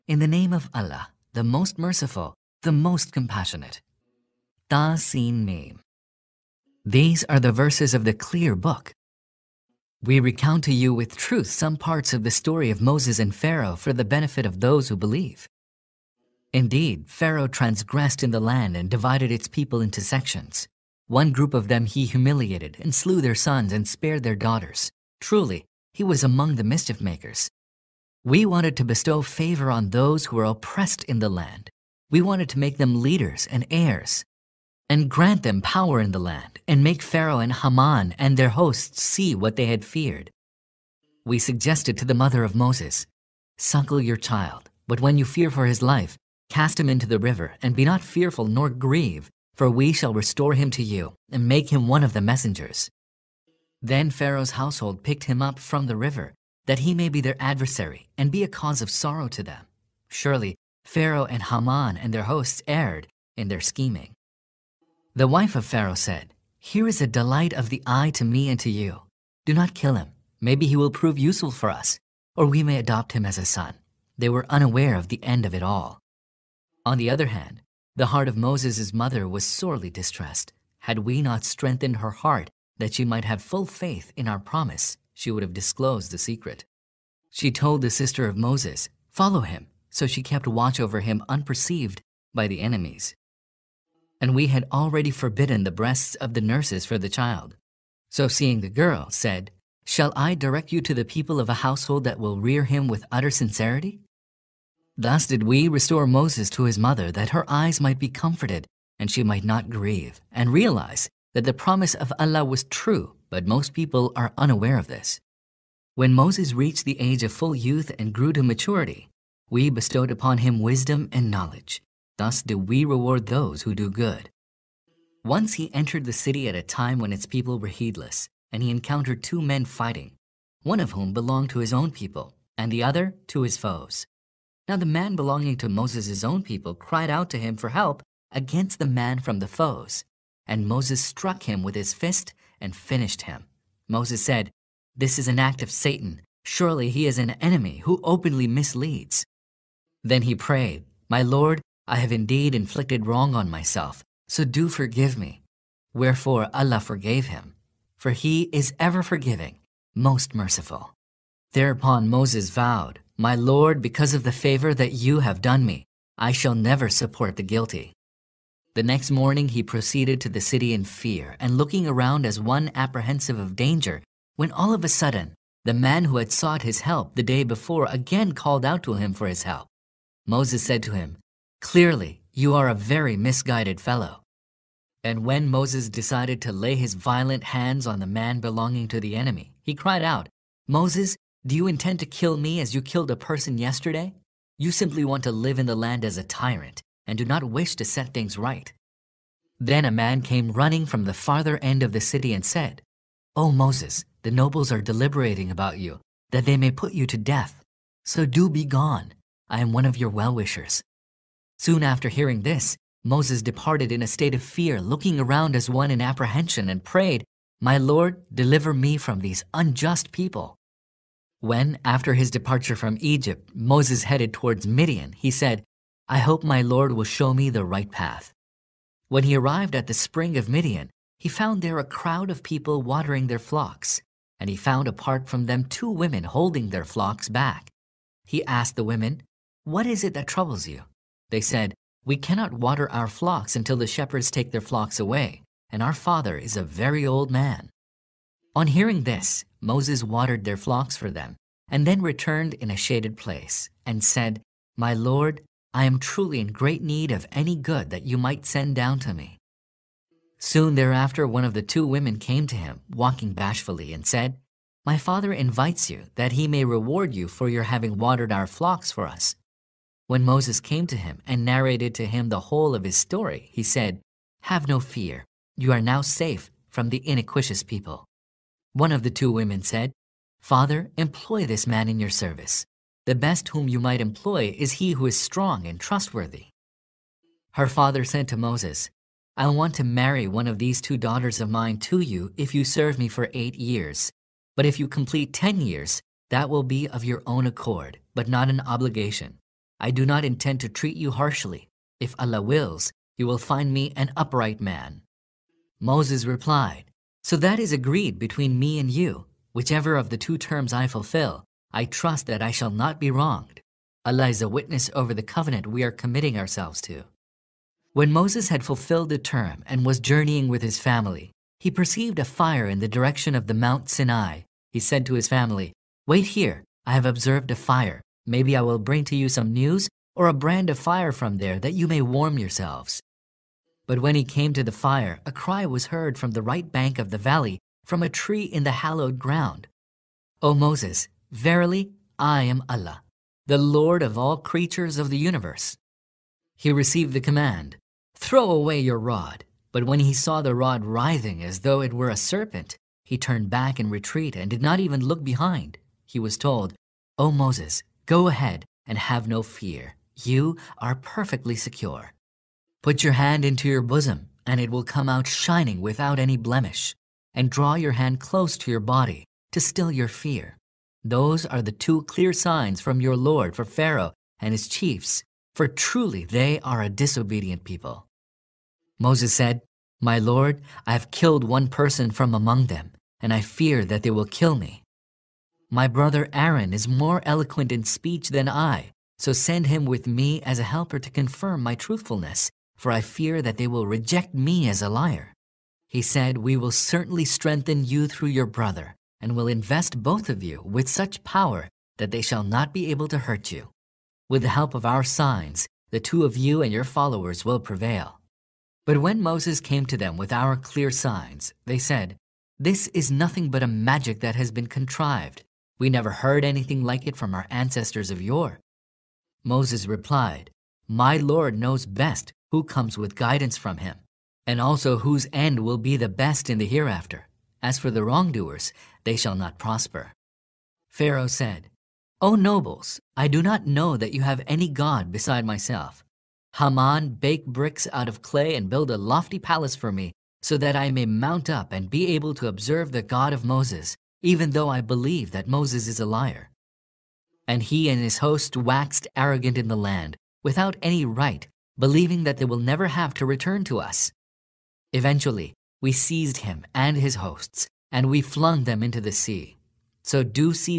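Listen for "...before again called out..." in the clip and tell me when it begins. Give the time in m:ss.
2:57.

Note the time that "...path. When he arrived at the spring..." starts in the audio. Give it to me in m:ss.
3:47.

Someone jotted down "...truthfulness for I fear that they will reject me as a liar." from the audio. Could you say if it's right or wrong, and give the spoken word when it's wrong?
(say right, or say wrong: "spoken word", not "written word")
right.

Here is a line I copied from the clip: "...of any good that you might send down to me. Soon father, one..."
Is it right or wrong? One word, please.
wrong.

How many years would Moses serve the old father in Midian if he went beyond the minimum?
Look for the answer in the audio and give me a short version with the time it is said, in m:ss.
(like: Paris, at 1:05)
10, at 4:55.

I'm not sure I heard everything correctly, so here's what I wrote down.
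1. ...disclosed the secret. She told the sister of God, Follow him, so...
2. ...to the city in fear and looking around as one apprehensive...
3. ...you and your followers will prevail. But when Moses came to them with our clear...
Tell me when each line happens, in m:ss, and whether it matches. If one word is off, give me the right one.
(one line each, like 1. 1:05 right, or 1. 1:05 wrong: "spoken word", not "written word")
1. 1:25 wrong: "Moses", not "God"
2. 2:50 right
3. 6:46 right.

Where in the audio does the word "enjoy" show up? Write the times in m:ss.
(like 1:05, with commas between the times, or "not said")
not said.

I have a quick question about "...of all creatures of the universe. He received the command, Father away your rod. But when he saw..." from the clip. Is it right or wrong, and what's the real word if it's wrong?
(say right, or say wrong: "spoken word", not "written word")
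wrong: "Throw", not "Father".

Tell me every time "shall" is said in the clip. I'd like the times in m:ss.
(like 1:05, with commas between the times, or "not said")
0:49, 1:39, 2:46, 5:12, 6:42, 7:09.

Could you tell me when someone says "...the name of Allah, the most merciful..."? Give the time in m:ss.
0:00.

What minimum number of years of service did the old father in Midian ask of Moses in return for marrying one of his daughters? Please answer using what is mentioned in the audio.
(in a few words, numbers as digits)
8.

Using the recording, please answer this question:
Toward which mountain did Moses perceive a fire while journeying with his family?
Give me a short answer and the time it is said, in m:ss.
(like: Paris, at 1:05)
Mount Sinai, at 5:23.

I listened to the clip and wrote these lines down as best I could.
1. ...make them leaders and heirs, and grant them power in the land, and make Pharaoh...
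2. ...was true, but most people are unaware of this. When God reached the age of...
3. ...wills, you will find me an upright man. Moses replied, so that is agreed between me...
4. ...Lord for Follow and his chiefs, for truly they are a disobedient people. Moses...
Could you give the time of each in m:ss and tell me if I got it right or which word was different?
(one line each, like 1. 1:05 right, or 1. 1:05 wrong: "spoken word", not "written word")
1. 0:32 right
2. 1:52 wrong: "Moses", not "God"
3. 5:02 right
4. 6:13 wrong: "Pharaoh", not "Follow".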